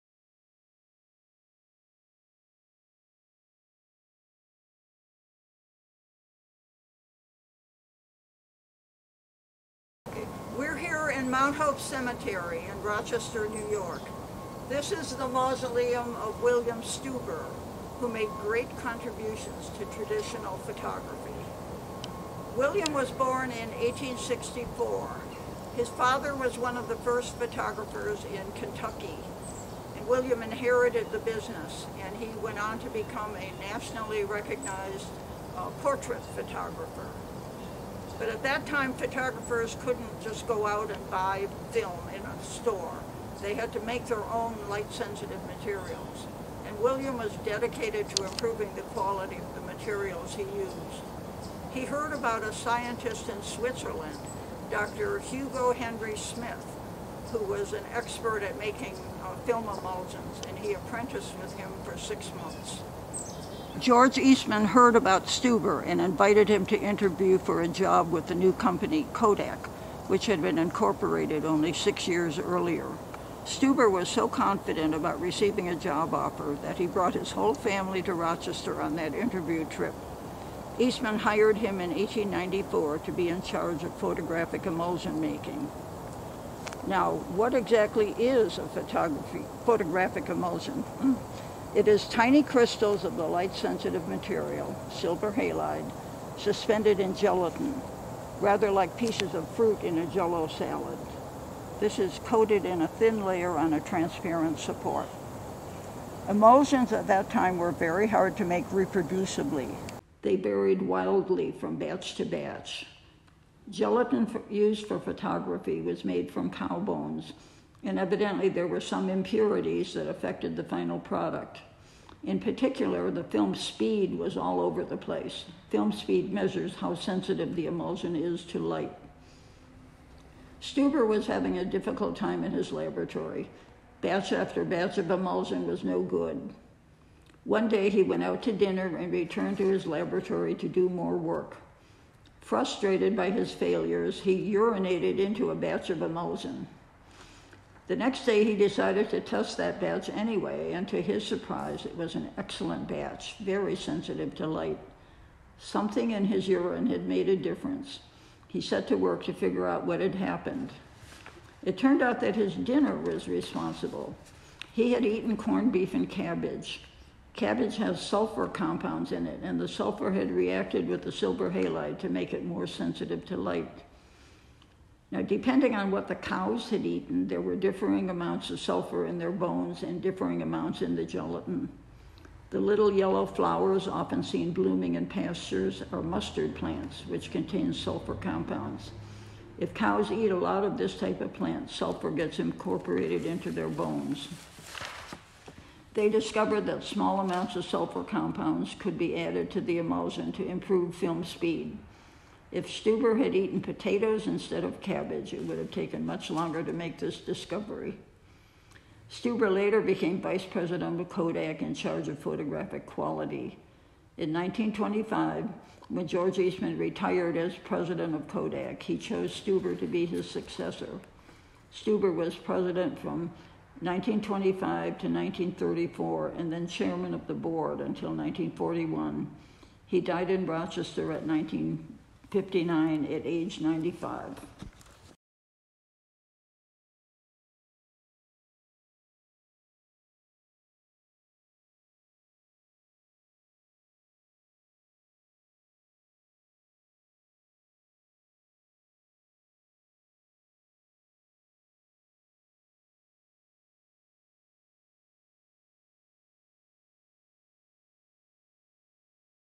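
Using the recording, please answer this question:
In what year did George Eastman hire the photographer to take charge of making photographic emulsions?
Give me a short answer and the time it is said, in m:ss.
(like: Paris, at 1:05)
1894, at 1:21.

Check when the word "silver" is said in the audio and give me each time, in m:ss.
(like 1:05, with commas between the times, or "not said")
1:34, 2:51.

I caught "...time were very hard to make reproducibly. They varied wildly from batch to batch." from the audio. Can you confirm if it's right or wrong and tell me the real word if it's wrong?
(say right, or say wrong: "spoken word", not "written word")
right.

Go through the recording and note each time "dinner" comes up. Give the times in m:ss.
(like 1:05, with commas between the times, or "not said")
2:18, 2:42.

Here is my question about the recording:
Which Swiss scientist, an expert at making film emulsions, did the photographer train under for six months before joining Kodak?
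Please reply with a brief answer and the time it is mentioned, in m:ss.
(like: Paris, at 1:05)
Hugo Henry Smith, at 0:54.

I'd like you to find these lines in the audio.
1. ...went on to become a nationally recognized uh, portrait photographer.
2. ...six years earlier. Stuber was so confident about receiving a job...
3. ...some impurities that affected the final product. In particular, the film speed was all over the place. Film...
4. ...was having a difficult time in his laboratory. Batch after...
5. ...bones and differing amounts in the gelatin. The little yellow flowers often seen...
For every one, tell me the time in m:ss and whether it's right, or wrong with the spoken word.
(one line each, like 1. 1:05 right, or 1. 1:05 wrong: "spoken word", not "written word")
1. 0:32 right
2. 1:11 right
3. 1:58 right
4. 2:11 right
5. 2:59 right.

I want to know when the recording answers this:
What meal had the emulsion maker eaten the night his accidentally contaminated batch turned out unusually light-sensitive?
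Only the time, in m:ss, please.
2:45.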